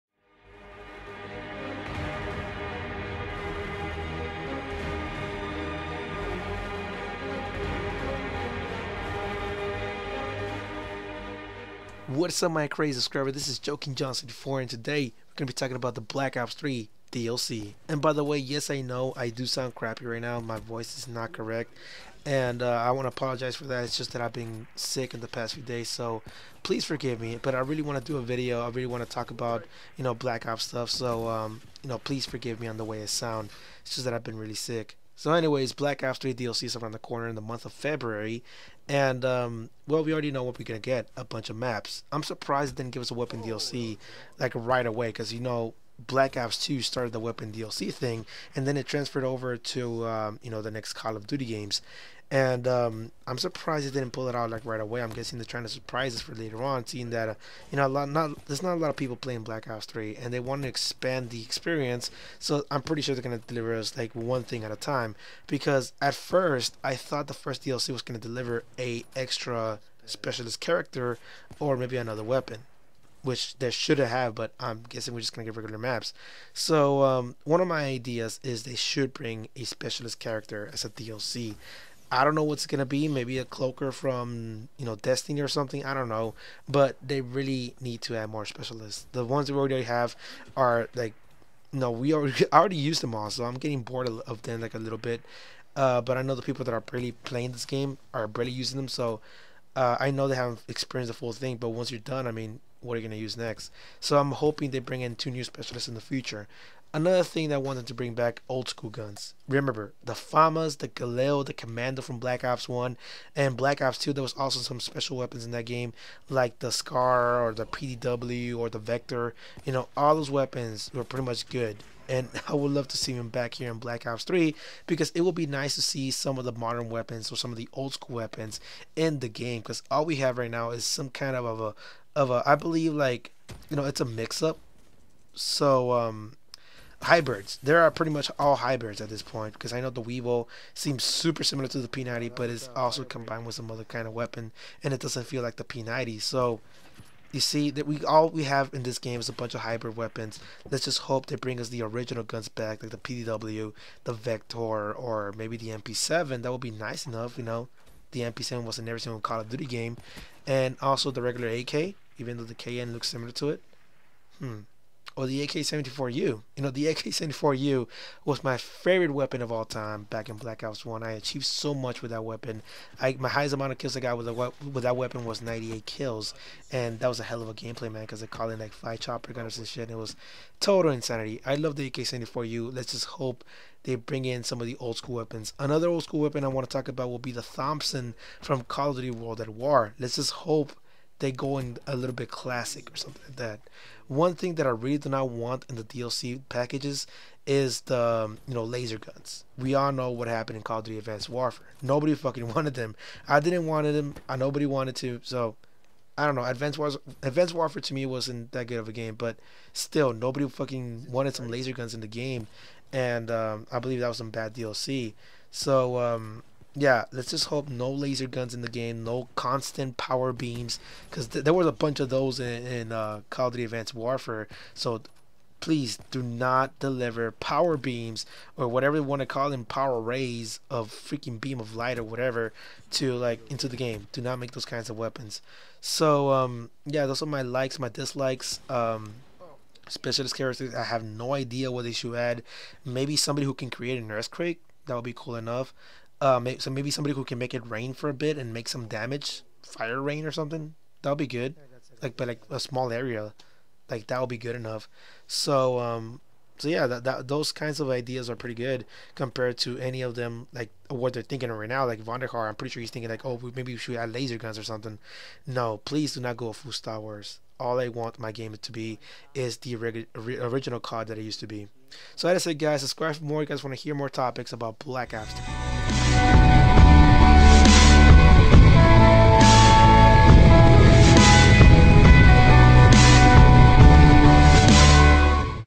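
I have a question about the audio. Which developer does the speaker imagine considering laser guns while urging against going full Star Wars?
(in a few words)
Vonderhaar.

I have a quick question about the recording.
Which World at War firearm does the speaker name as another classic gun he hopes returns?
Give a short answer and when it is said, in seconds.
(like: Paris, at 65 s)
Thompson, at 187 s.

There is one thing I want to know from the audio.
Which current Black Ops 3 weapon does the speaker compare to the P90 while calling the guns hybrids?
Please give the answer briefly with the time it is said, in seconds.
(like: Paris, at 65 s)
Weevil, at 140 s.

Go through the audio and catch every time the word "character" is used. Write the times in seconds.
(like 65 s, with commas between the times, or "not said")
70 s, 80 s, 240 s.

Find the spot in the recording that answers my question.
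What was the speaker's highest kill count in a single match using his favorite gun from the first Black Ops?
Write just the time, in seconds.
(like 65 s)
175 s.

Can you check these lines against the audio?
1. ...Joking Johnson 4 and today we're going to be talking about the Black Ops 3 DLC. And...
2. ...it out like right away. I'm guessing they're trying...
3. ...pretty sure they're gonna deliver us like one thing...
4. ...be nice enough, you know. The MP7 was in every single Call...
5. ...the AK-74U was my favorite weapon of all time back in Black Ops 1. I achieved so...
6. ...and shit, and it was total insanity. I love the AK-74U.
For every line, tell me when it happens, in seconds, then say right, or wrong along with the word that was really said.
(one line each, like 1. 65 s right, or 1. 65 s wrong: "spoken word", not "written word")
1. 13 s right
2. 54 s right
3. 62 s right
4. 156 s right
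5. 166 s right
6. 179 s right.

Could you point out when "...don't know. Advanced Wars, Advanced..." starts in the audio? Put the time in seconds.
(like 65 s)
206 s.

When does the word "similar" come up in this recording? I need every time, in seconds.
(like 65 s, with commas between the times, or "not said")
141 s, 163 s.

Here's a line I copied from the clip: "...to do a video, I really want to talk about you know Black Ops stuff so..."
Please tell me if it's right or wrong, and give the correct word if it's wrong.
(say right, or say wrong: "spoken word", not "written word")
right.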